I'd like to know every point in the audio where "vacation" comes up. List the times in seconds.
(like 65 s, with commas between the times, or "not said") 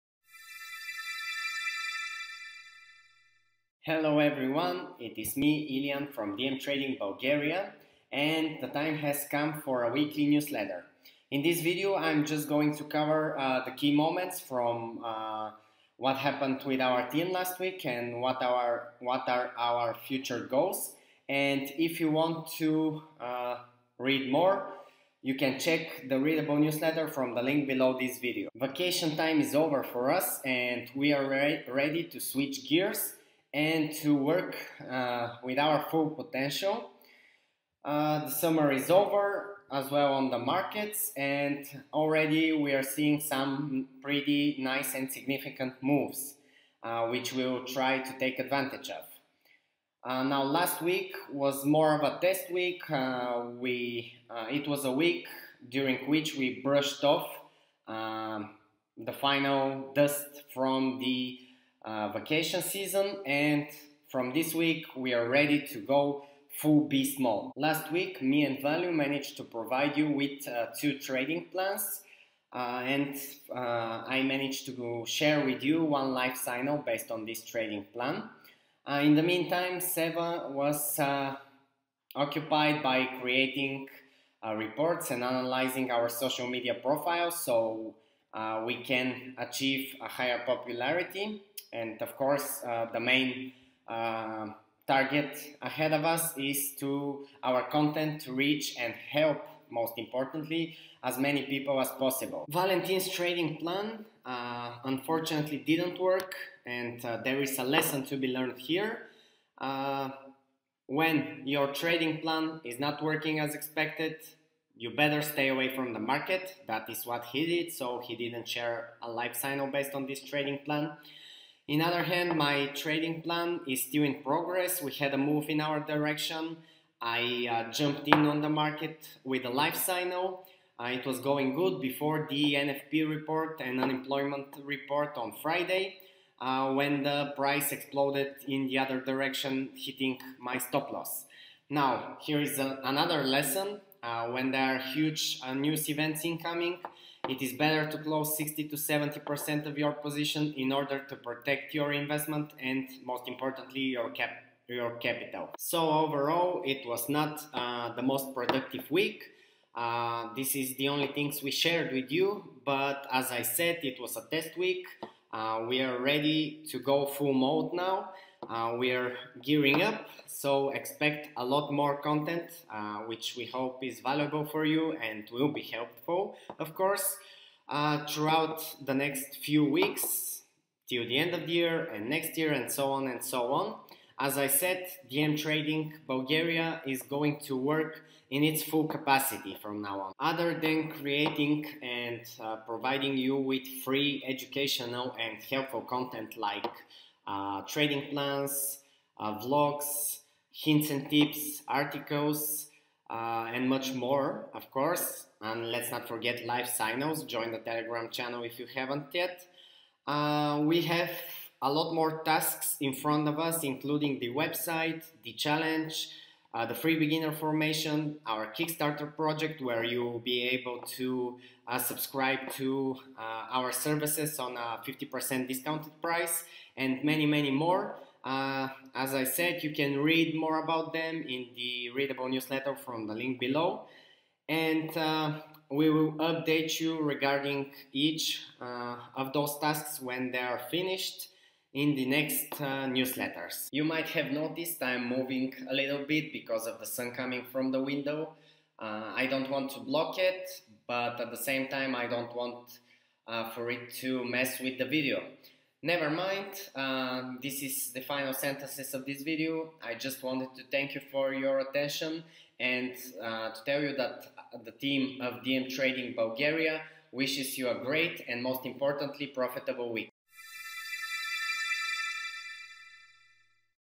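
28 s, 62 s.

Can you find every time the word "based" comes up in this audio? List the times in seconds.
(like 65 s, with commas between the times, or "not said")
76 s, 119 s.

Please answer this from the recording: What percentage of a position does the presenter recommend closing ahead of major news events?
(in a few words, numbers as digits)
60 to 70%.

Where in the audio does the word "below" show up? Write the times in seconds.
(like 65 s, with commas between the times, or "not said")
27 s, 233 s.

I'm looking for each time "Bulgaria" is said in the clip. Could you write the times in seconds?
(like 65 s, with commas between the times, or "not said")
6 s, 186 s, 266 s.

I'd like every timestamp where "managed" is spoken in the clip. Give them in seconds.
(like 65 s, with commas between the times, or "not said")
68 s, 74 s.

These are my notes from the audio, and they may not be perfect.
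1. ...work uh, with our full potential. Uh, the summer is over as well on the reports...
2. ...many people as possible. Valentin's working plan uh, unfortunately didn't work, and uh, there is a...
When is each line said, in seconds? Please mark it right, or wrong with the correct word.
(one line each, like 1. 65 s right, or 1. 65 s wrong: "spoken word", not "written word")
1. 34 s wrong: "markets", not "reports"
2. 101 s wrong: "trading", not "working".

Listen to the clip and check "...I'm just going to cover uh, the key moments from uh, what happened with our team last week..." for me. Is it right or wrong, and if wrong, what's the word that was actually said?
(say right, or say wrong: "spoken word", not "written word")
right.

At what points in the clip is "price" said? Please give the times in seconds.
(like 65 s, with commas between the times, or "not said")
137 s, 226 s.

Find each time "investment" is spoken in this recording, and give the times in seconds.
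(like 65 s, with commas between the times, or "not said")
151 s.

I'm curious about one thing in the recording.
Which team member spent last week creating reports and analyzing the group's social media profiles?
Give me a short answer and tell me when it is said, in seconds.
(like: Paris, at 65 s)
Seva, at 79 s.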